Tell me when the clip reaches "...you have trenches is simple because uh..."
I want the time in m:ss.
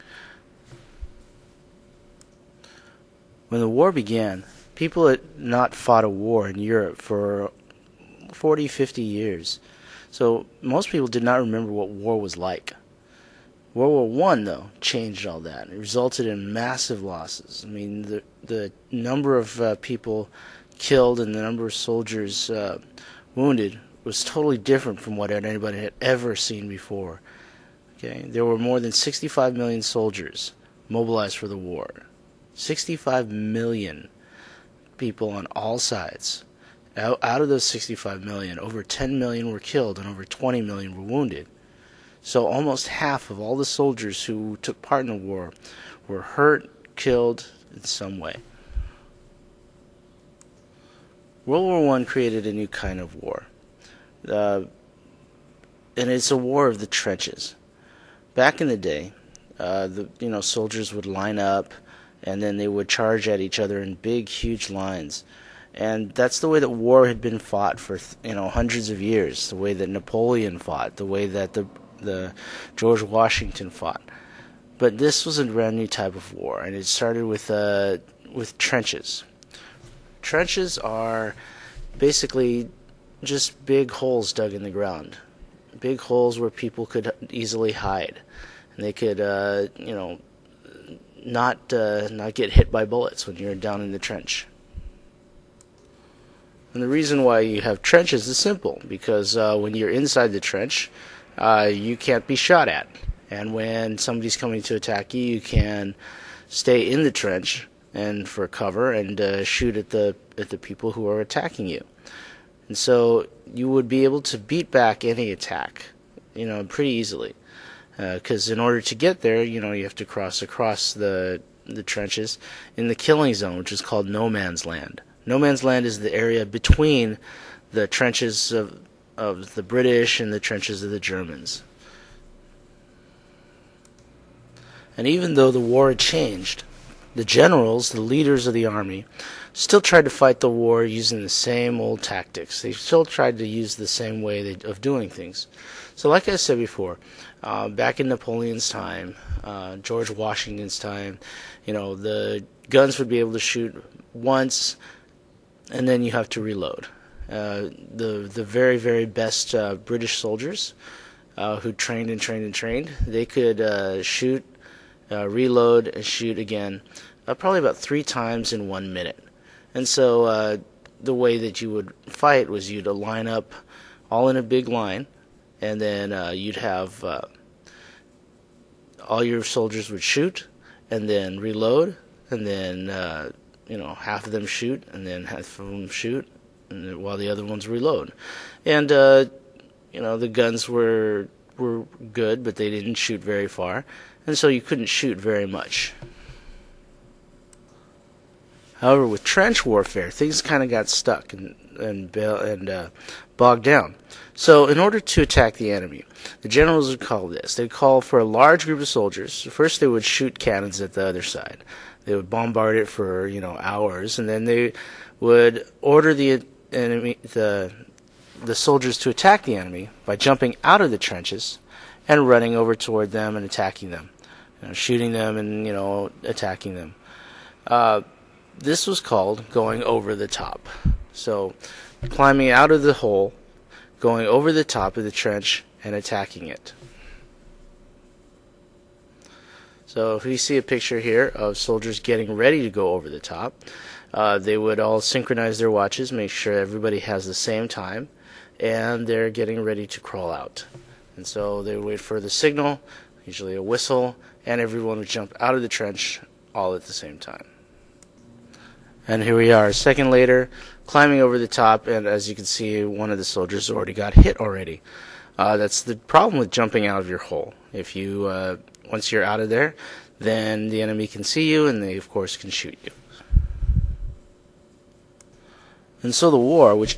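1:37.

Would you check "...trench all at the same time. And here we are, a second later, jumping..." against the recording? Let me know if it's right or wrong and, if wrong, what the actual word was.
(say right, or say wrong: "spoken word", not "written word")
wrong: "climbing", not "jumping".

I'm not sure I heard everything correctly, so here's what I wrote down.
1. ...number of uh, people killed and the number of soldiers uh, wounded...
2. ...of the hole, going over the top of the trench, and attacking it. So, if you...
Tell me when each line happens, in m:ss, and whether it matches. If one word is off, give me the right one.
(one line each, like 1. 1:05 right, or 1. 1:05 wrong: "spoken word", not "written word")
1. 0:18 right
2. 3:52 right.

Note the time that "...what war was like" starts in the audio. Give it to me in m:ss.
0:11.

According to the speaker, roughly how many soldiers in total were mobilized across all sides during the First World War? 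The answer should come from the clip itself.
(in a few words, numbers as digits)
65 million.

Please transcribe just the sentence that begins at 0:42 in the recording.
So almost half of all the soldiers who took part in the war were hurt, killed in some way.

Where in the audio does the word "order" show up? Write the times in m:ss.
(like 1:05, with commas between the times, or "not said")
1:58, 3:24, 3:35.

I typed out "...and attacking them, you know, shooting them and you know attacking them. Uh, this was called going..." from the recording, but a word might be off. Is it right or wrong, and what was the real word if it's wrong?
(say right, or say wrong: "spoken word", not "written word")
right.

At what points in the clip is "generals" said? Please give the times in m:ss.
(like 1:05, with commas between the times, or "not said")
2:17, 3:26.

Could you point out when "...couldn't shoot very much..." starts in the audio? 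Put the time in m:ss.
3:14.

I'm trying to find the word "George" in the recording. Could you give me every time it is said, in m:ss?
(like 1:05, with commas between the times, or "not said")
1:12, 2:29.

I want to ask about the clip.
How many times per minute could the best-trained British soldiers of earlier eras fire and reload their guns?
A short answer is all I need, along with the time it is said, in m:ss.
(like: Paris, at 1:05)
3, at 2:47.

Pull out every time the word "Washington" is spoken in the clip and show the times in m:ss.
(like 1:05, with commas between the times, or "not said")
1:13, 2:30.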